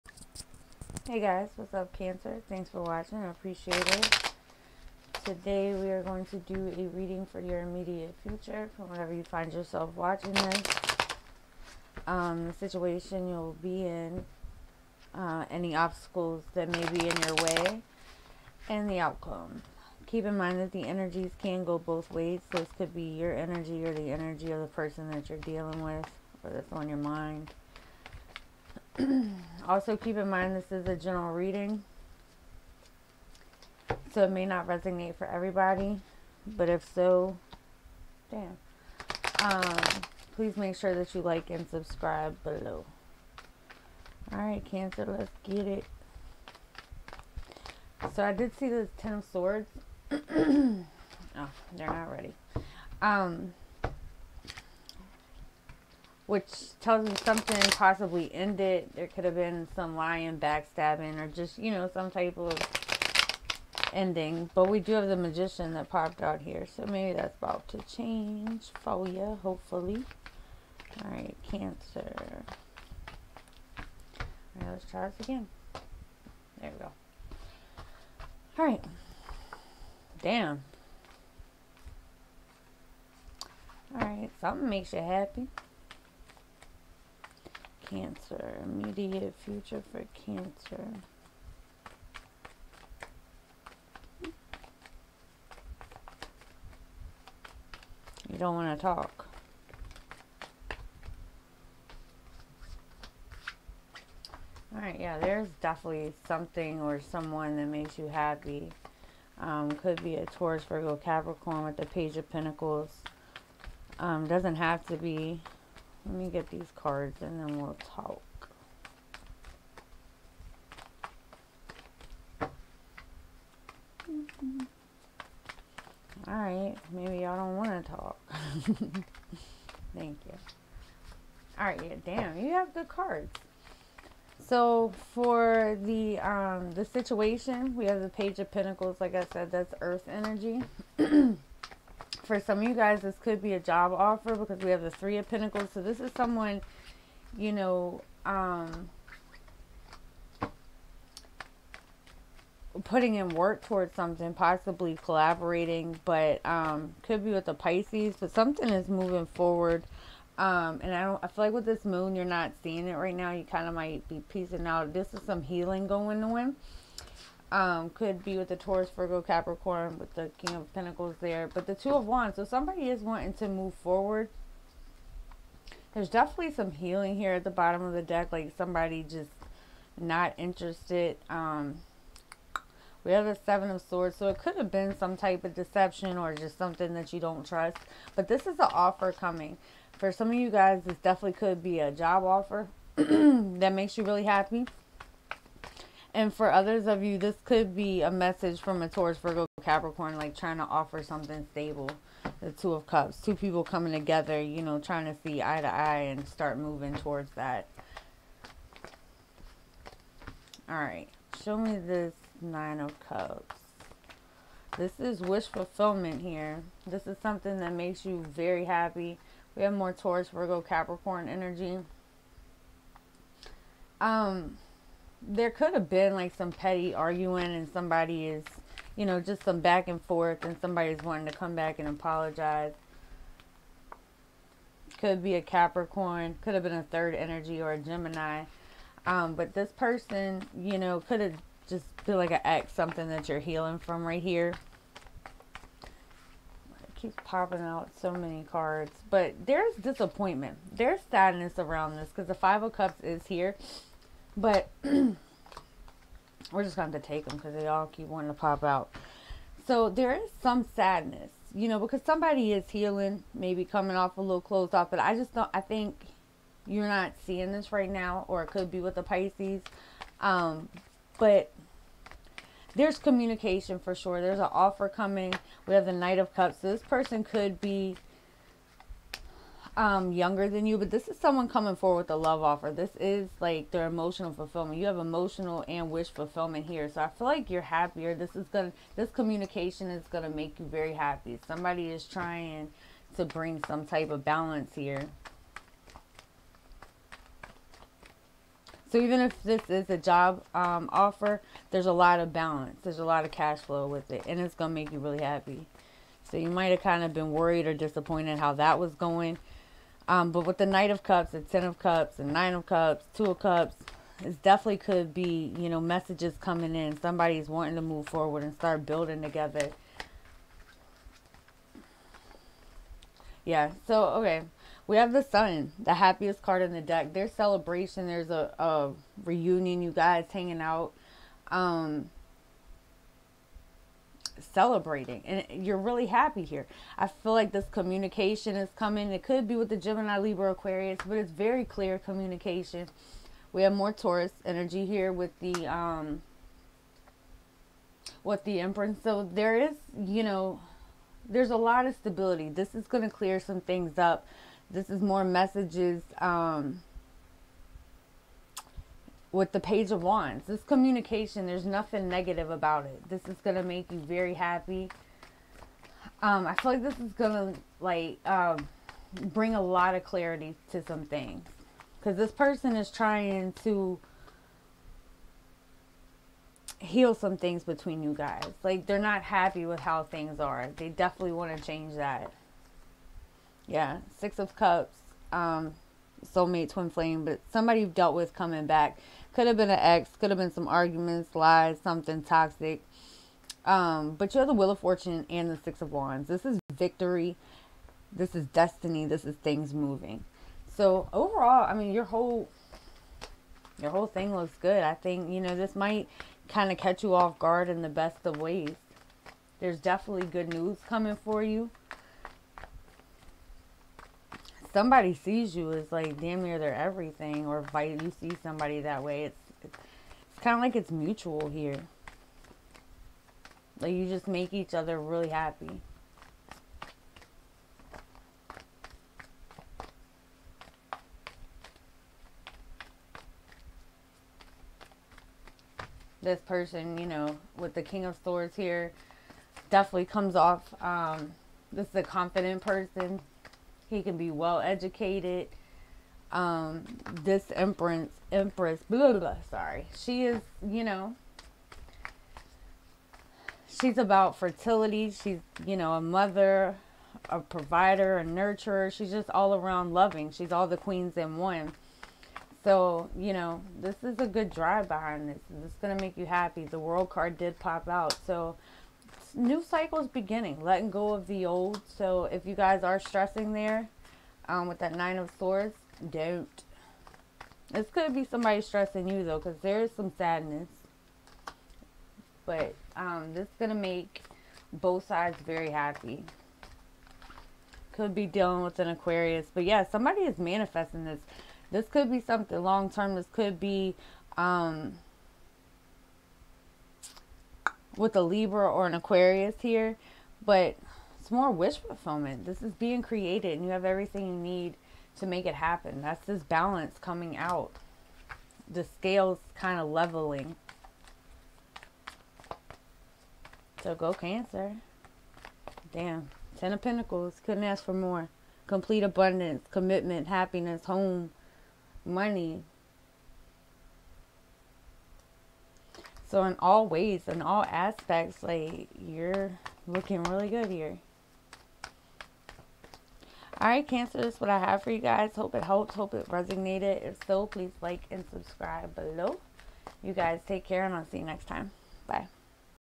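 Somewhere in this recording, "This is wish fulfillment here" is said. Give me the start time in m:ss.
3:34.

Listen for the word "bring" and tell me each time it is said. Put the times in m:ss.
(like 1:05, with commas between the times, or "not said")
4:53, 6:09.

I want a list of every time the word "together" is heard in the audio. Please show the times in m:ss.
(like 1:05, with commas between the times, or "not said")
3:23, 5:19.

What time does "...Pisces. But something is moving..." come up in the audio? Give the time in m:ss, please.
2:37.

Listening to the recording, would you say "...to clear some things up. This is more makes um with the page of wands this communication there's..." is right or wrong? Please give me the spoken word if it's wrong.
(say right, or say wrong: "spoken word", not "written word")
wrong: "messages", not "makes".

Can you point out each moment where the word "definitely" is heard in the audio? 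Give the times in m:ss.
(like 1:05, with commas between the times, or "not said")
1:45, 2:56, 3:11, 5:14, 6:20, 6:49, 7:19.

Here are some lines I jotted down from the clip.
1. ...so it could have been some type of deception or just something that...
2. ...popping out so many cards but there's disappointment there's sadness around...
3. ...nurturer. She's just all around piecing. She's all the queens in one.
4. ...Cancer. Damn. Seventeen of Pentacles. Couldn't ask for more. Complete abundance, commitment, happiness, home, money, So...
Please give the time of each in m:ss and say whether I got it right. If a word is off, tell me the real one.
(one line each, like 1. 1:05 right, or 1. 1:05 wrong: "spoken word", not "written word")
1. 3:04 right
2. 4:07 right
3. 7:38 wrong: "loving", not "piecing"
4. 8:34 wrong: "Ten", not "Seventeen".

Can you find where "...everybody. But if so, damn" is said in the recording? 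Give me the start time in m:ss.
0:35.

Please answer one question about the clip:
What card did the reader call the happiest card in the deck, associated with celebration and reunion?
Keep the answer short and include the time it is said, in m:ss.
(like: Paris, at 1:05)
The Sun, at 5:25.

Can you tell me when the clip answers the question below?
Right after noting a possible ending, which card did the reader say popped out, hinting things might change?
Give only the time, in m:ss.
1:05.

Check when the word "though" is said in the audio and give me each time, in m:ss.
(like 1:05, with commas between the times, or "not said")
7:59.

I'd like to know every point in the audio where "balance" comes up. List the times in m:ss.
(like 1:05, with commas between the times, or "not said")
4:54, 5:02, 8:26.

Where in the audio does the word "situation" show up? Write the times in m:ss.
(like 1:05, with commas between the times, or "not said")
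0:12, 2:16.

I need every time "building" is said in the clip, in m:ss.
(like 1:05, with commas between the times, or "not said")
5:18.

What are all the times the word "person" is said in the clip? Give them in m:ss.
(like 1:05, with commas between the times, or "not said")
0:24, 3:59, 4:36, 6:12, 7:16, 7:22.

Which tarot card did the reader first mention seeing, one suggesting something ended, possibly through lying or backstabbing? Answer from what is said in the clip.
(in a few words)
Ten of Swords.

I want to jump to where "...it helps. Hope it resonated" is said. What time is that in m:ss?
8:55.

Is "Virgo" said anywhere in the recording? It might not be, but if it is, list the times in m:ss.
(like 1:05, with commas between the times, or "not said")
1:50, 2:48, 3:19, 3:40.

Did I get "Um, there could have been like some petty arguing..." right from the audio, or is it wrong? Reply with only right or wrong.
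right.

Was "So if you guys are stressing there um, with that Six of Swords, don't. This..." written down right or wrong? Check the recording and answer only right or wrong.
wrong.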